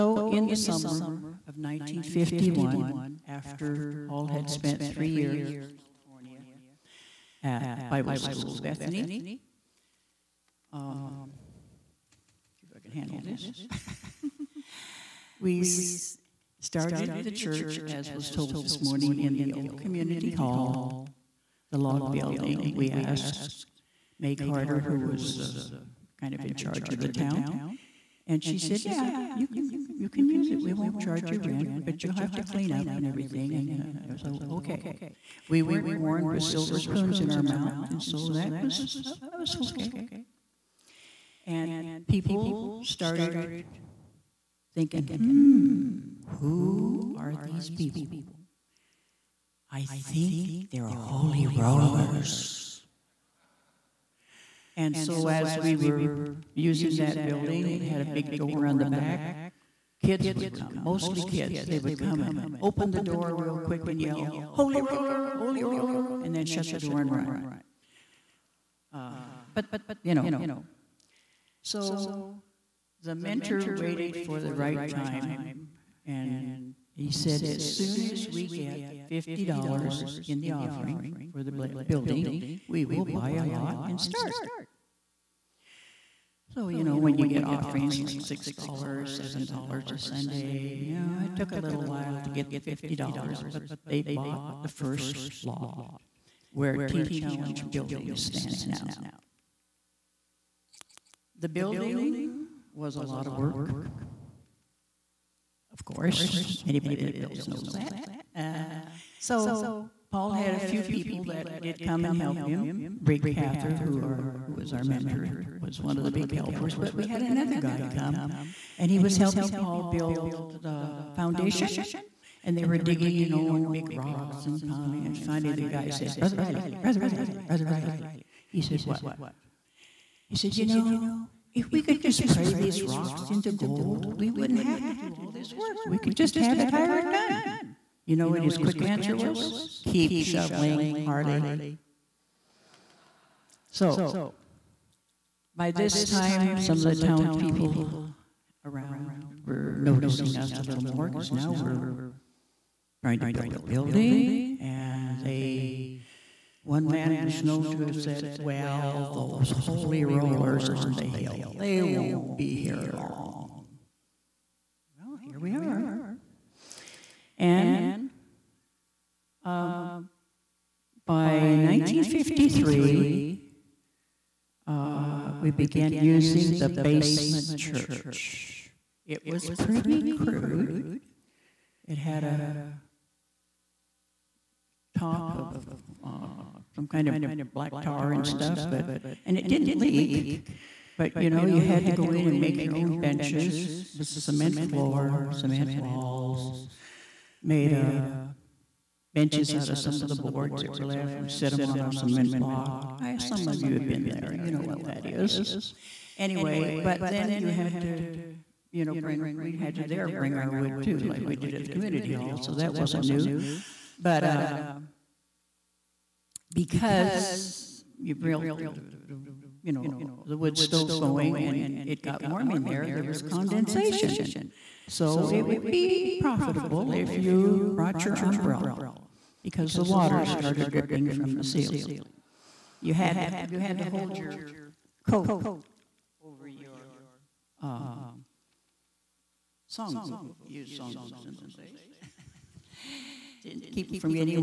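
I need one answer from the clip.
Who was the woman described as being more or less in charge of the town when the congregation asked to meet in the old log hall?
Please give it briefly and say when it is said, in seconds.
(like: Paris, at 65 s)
May Carter, at 24 s.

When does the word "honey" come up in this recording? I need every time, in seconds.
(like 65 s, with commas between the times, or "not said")
not said.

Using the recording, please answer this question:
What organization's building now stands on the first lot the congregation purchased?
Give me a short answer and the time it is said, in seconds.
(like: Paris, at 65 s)
Teen Challenge, at 96 s.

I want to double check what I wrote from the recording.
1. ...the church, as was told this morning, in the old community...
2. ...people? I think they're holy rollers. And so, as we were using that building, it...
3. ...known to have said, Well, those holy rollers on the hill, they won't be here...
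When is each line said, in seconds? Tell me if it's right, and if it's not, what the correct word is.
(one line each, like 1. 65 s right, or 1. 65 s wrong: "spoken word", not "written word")
1. 17 s right
2. 47 s right
3. 157 s right.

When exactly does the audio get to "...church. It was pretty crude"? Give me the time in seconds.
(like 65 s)
177 s.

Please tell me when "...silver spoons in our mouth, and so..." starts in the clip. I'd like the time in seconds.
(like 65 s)
36 s.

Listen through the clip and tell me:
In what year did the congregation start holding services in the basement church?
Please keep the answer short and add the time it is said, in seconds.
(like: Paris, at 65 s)
1953, at 171 s.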